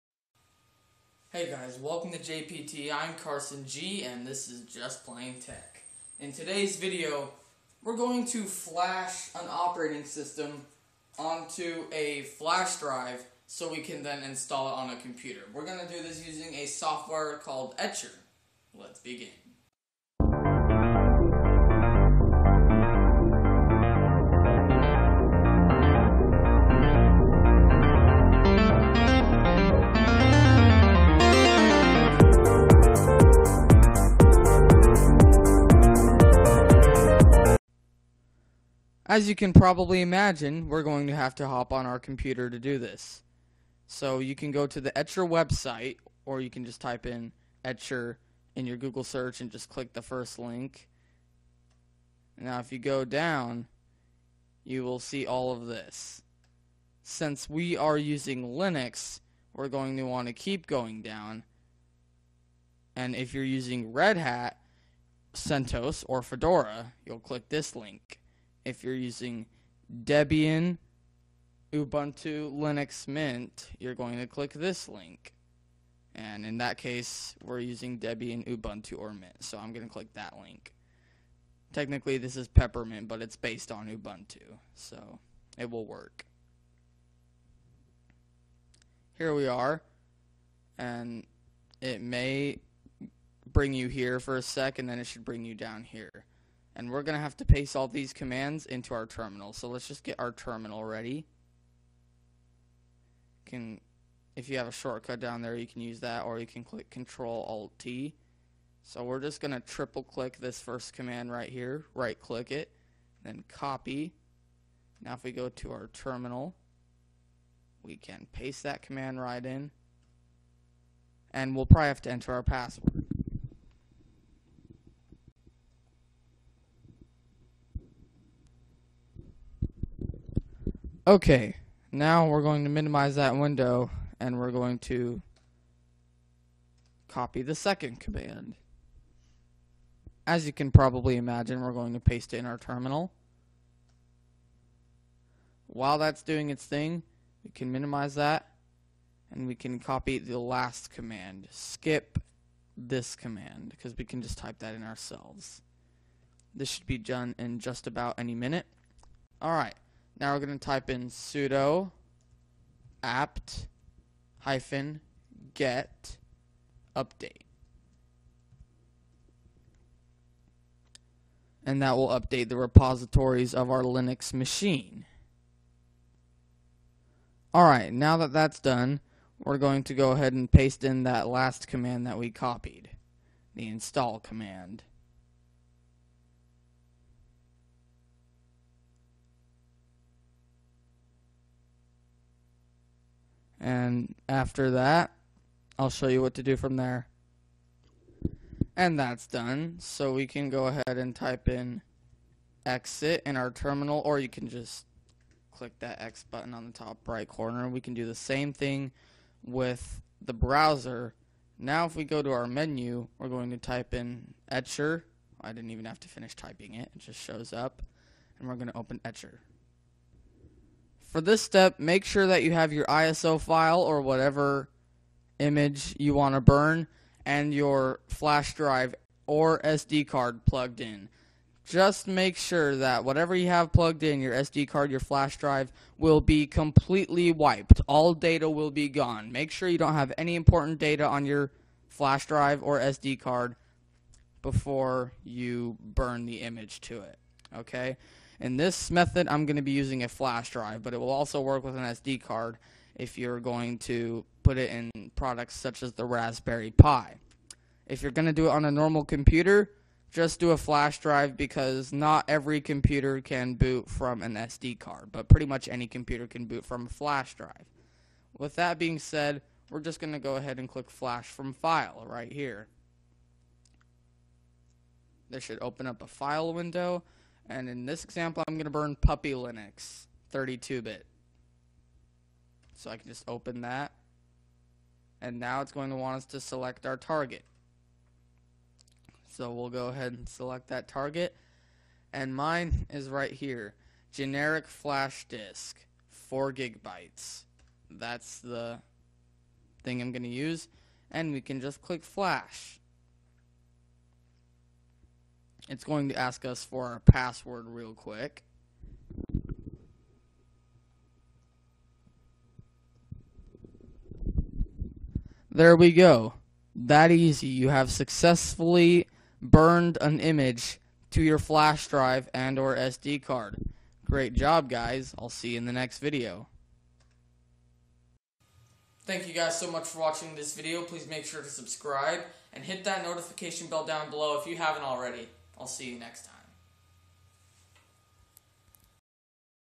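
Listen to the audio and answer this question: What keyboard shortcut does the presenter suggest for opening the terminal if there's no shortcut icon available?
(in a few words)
Control-Alt-T.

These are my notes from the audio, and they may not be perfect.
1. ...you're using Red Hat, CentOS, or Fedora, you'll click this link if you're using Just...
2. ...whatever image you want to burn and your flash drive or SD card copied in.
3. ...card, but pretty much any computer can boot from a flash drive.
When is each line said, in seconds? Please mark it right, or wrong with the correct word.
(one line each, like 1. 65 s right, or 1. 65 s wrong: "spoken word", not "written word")
1. 63 s wrong: "Debian", not "Just"
2. 224 s wrong: "plugged", not "copied"
3. 264 s right.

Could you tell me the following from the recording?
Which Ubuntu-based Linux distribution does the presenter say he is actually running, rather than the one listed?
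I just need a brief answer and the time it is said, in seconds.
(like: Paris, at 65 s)
Peppermint, at 82 s.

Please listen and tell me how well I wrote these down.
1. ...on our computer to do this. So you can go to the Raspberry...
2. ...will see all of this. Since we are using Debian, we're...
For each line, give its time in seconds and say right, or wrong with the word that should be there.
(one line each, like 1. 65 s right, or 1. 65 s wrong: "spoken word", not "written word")
1. 41 s wrong: "Etcher", not "Raspberry"
2. 54 s wrong: "Linux", not "Debian".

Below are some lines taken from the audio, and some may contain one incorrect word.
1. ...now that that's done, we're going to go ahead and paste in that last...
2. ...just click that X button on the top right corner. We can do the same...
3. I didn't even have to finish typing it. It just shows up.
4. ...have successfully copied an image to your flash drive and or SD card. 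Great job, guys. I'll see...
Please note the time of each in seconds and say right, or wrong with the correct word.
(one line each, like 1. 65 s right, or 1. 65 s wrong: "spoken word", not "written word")
1. 177 s right
2. 204 s right
3. 215 s right
4. 317 s wrong: "burned", not "copied".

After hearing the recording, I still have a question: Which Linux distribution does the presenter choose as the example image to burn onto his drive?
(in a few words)
Puppy Linux.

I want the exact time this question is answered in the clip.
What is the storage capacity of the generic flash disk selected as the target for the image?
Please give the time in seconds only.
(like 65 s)
296 s.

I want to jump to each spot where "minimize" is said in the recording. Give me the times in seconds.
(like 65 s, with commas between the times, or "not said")
132 s, 147 s.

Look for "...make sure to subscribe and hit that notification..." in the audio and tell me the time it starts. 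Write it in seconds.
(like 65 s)
331 s.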